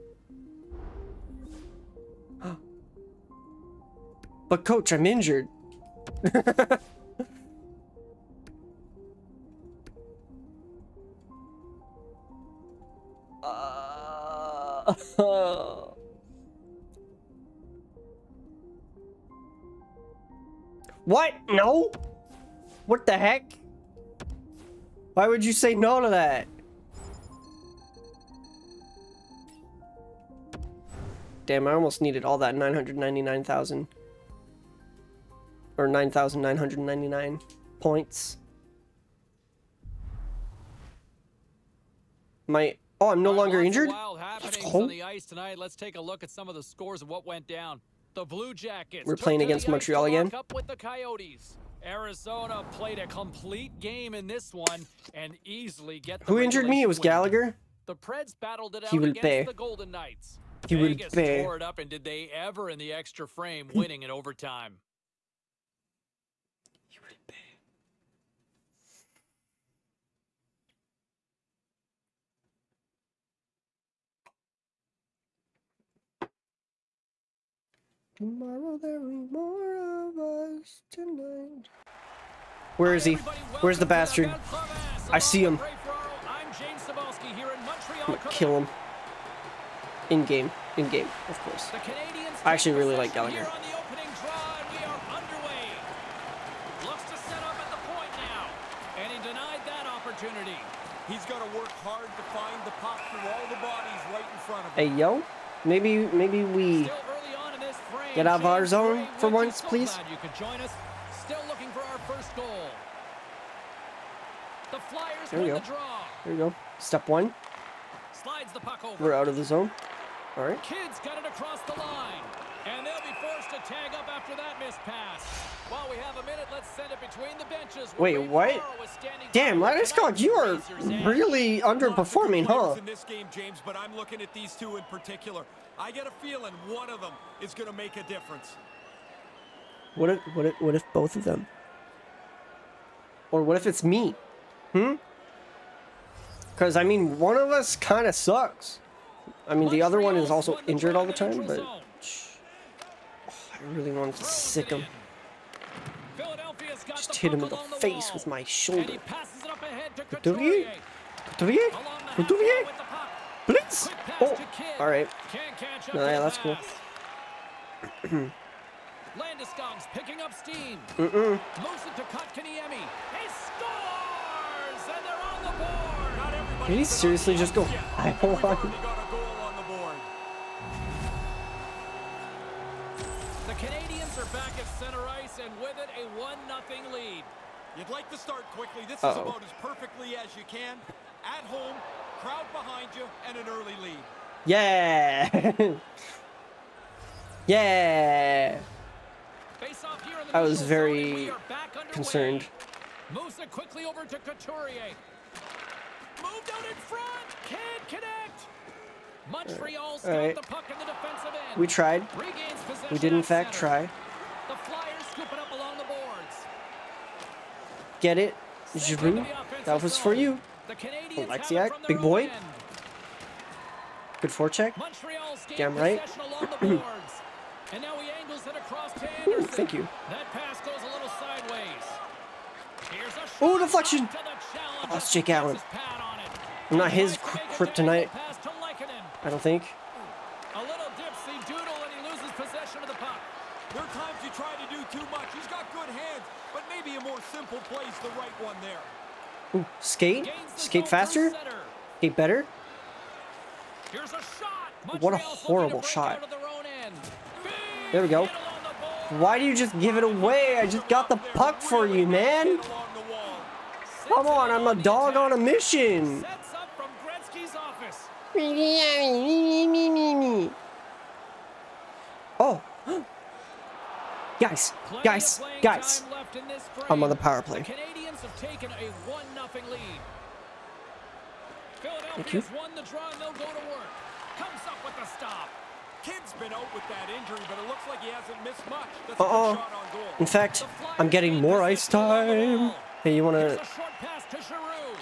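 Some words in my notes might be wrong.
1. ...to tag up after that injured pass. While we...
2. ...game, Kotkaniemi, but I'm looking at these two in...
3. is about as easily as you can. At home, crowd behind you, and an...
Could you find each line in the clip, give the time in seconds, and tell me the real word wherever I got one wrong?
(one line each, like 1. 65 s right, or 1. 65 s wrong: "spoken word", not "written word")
1. 123 s wrong: "missed", not "injured"
2. 133 s wrong: "James", not "Kotkaniemi"
3. 189 s wrong: "perfectly", not "easily".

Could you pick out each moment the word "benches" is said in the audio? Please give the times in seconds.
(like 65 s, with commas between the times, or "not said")
127 s.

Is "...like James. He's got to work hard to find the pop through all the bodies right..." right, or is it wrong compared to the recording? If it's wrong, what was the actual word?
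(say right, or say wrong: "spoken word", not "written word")
wrong: "Gallagher", not "James".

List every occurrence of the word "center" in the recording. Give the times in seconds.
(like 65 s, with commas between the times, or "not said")
184 s, 213 s.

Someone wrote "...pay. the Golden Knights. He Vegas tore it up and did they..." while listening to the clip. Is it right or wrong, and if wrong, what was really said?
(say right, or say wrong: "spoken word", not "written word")
right.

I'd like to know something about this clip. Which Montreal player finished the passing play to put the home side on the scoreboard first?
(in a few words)
Kotkaniemi.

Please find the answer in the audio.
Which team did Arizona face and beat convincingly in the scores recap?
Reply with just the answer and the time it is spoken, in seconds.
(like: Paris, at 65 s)
Blue Jackets, at 48 s.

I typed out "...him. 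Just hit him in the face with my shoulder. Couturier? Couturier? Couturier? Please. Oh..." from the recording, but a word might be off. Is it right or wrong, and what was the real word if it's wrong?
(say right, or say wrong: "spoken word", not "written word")
right.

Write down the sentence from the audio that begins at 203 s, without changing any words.
Moves it quickly over to Couturier.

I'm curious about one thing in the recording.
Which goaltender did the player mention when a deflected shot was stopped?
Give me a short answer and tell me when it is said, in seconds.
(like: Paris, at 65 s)
Jake Allen, at 235 s.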